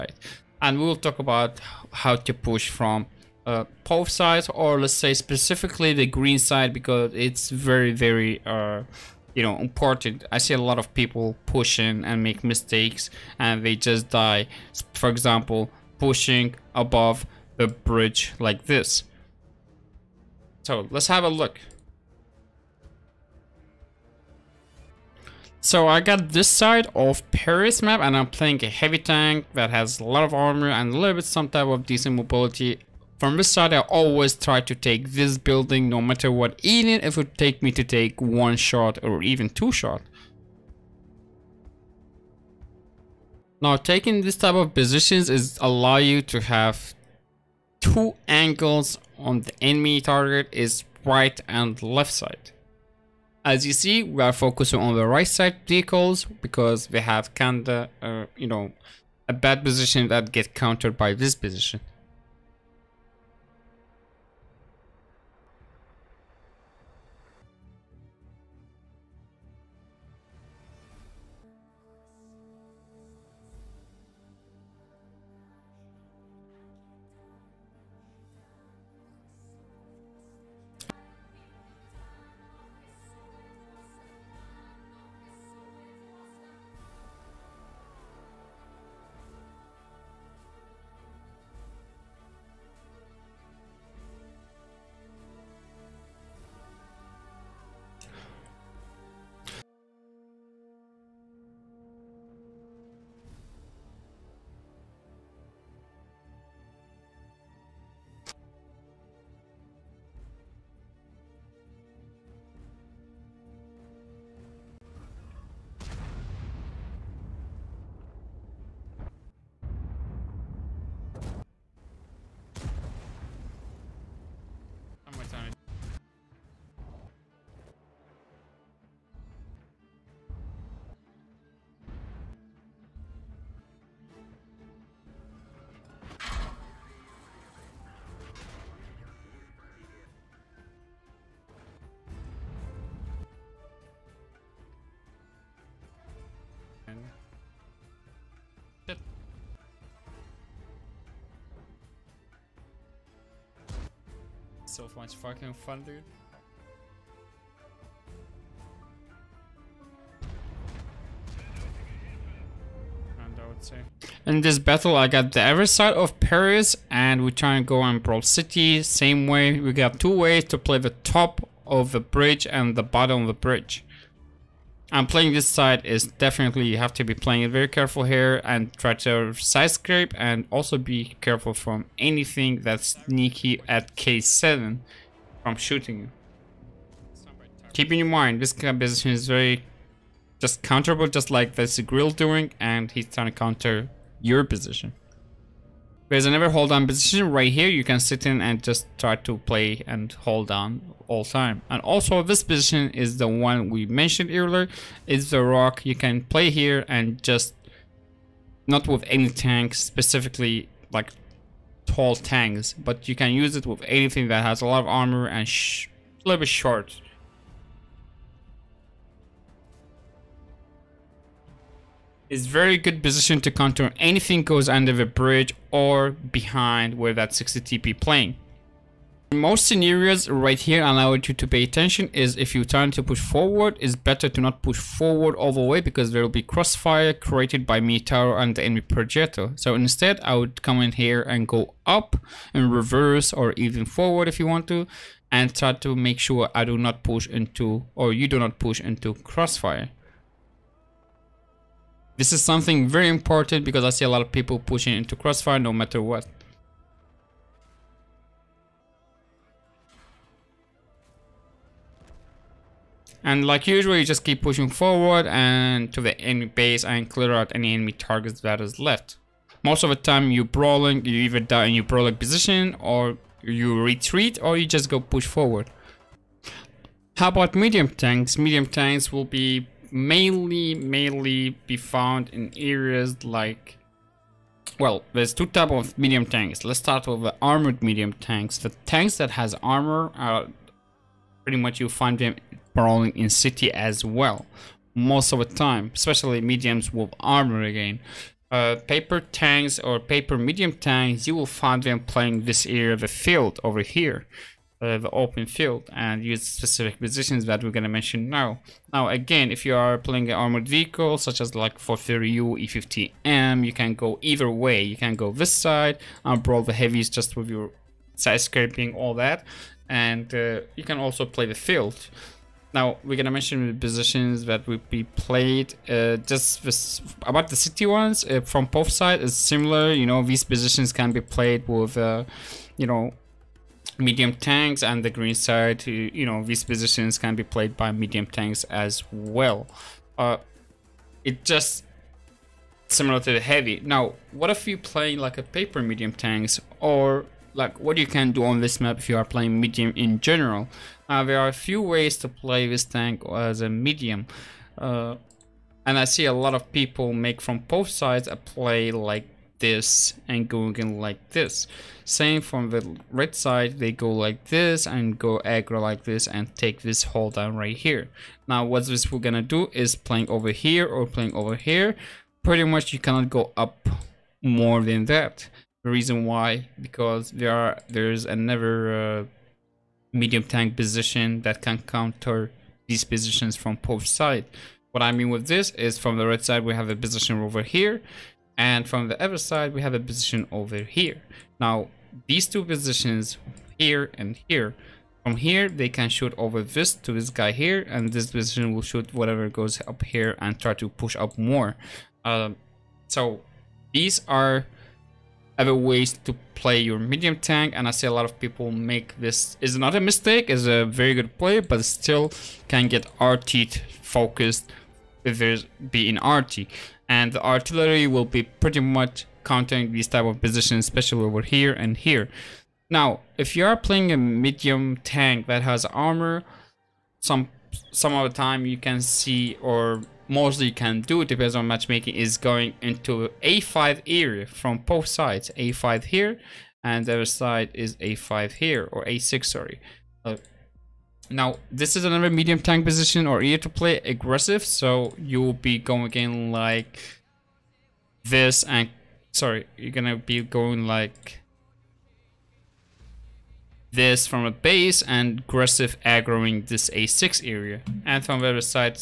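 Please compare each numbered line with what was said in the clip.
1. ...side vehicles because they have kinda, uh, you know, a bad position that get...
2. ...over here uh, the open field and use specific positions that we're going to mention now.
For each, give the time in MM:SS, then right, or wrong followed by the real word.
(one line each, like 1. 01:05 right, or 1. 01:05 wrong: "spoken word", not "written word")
1. 00:55 right
2. 05:03 right.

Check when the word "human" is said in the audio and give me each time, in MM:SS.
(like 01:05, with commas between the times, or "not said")
not said.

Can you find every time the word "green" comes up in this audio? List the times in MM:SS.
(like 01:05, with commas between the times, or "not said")
00:06, 05:35.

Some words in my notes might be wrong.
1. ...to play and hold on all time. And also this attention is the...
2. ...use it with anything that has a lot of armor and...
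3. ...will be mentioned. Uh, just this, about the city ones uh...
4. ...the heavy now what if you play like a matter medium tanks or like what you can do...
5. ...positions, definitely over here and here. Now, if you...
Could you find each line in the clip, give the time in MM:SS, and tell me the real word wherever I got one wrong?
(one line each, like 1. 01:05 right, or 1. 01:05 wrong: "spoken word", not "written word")
1. 03:19 wrong: "position", not "attention"
2. 03:33 right
3. 05:24 wrong: "played", not "mentioned"
4. 05:43 wrong: "paper", not "matter"
5. 07:00 wrong: "especially", not "definitely".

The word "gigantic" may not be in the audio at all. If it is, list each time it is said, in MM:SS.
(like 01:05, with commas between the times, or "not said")
not said.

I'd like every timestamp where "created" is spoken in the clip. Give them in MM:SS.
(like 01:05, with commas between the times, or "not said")
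03:57.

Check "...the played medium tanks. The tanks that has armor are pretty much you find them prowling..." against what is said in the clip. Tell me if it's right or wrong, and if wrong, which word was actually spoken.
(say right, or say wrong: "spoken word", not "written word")
wrong: "armored", not "played".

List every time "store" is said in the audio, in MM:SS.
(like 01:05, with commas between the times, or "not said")
not said.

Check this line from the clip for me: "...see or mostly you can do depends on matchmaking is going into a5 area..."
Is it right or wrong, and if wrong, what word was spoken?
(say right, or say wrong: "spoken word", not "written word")
right.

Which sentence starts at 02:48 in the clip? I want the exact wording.
Same way, we got two ways to play the top of the bridge and the bottom of the bridge.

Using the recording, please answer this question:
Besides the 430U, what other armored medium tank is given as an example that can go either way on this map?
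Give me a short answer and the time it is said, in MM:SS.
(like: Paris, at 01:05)
E50M, at 05:12.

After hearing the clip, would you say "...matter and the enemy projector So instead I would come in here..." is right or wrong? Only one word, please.
wrong.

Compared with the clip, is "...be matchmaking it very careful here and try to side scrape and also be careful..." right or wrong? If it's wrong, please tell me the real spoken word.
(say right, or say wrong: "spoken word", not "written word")
wrong: "playing", not "matchmaking".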